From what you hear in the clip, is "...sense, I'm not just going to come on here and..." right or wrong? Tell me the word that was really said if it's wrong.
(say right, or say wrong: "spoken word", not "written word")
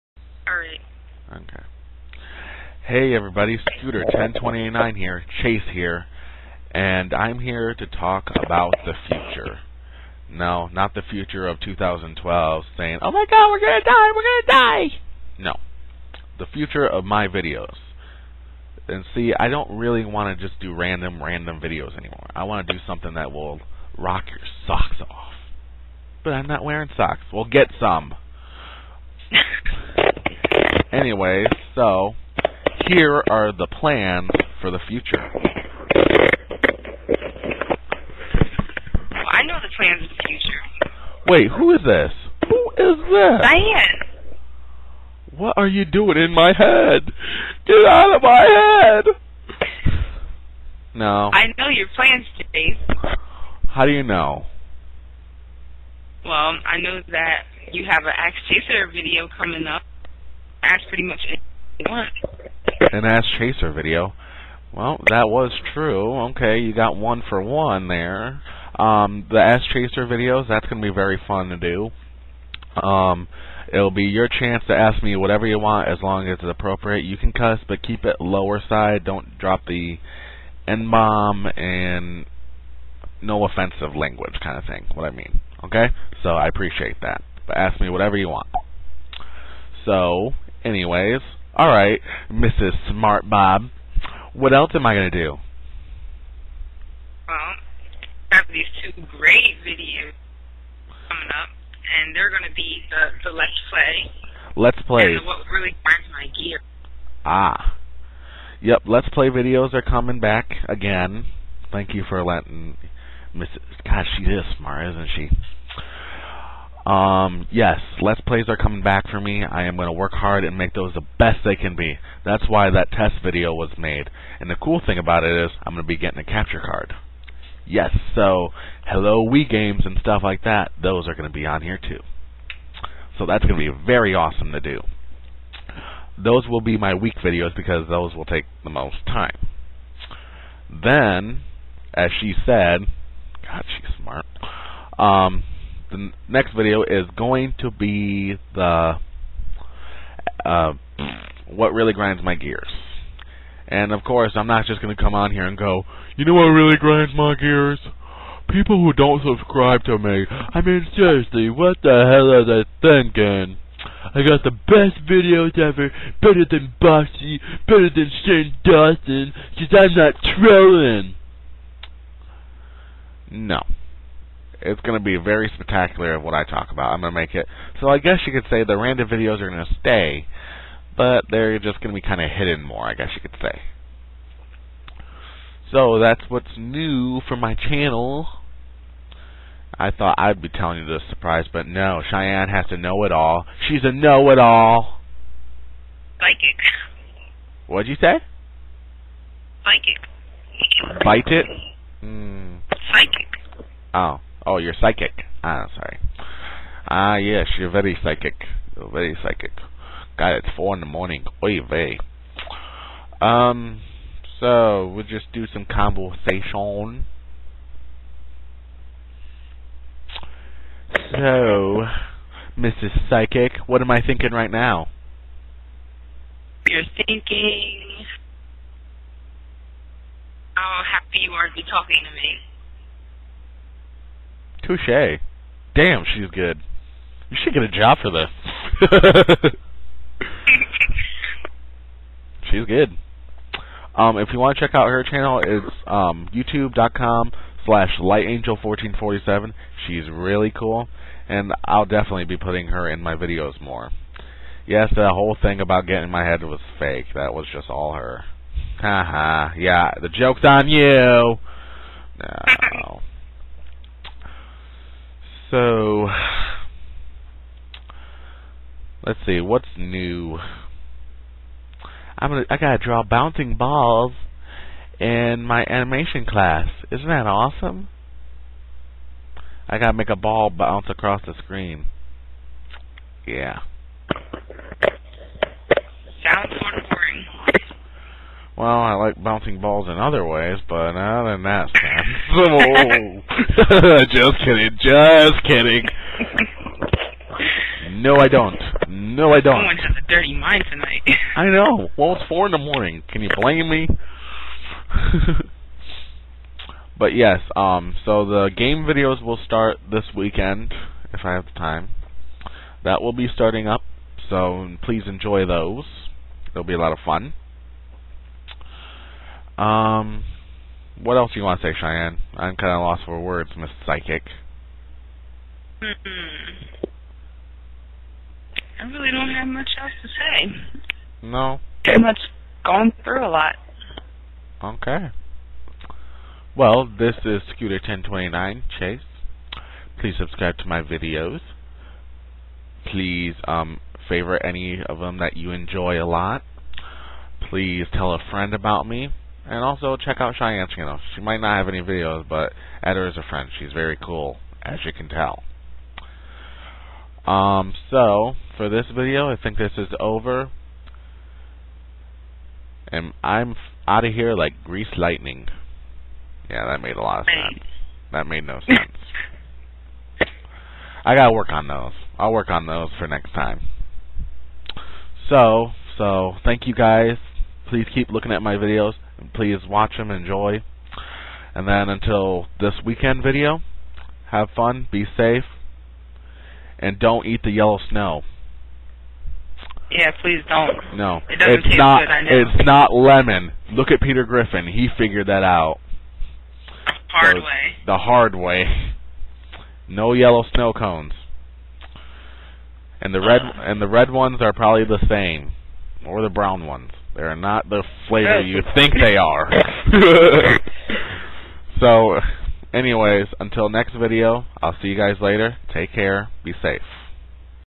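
wrong: "course", not "sense".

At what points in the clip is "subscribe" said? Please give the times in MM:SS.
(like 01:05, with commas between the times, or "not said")
02:39, 05:40.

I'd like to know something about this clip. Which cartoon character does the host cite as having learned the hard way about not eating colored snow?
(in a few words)
Peter Griffin.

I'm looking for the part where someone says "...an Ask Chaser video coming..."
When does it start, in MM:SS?
00:58.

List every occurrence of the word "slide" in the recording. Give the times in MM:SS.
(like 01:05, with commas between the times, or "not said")
not said.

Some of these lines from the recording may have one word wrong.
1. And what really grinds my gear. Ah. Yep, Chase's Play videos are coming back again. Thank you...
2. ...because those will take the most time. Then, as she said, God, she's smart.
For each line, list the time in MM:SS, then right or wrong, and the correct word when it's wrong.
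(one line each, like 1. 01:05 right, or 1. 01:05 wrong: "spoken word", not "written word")
1. 01:45 wrong: "Let", not "Chase"
2. 02:17 right.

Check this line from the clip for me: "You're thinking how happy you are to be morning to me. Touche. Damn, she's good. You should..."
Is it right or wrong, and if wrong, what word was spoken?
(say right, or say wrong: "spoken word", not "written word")
wrong: "talking", not "morning".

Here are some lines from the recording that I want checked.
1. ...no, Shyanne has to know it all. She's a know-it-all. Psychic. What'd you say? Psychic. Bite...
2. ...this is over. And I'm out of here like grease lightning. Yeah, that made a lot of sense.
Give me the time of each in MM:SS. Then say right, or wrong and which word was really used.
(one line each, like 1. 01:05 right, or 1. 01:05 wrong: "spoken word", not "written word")
1. 03:11 right
2. 05:59 right.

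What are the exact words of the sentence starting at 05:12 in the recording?
That will be starting up, so please enjoy those.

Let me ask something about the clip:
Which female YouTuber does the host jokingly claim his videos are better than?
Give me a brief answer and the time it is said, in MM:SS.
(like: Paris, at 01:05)
Boxxy, at 02:46.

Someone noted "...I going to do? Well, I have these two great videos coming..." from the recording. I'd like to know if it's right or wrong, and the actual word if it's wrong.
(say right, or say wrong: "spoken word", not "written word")
right.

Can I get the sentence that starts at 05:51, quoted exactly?
She might not have any videos, but Eder is a friend.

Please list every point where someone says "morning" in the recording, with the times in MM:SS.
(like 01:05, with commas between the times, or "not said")
03:30, 05:02.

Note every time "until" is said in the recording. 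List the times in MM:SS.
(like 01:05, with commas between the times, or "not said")
06:21, 06:53.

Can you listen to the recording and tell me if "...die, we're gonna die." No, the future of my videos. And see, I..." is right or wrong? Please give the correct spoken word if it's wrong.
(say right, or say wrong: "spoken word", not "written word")
right.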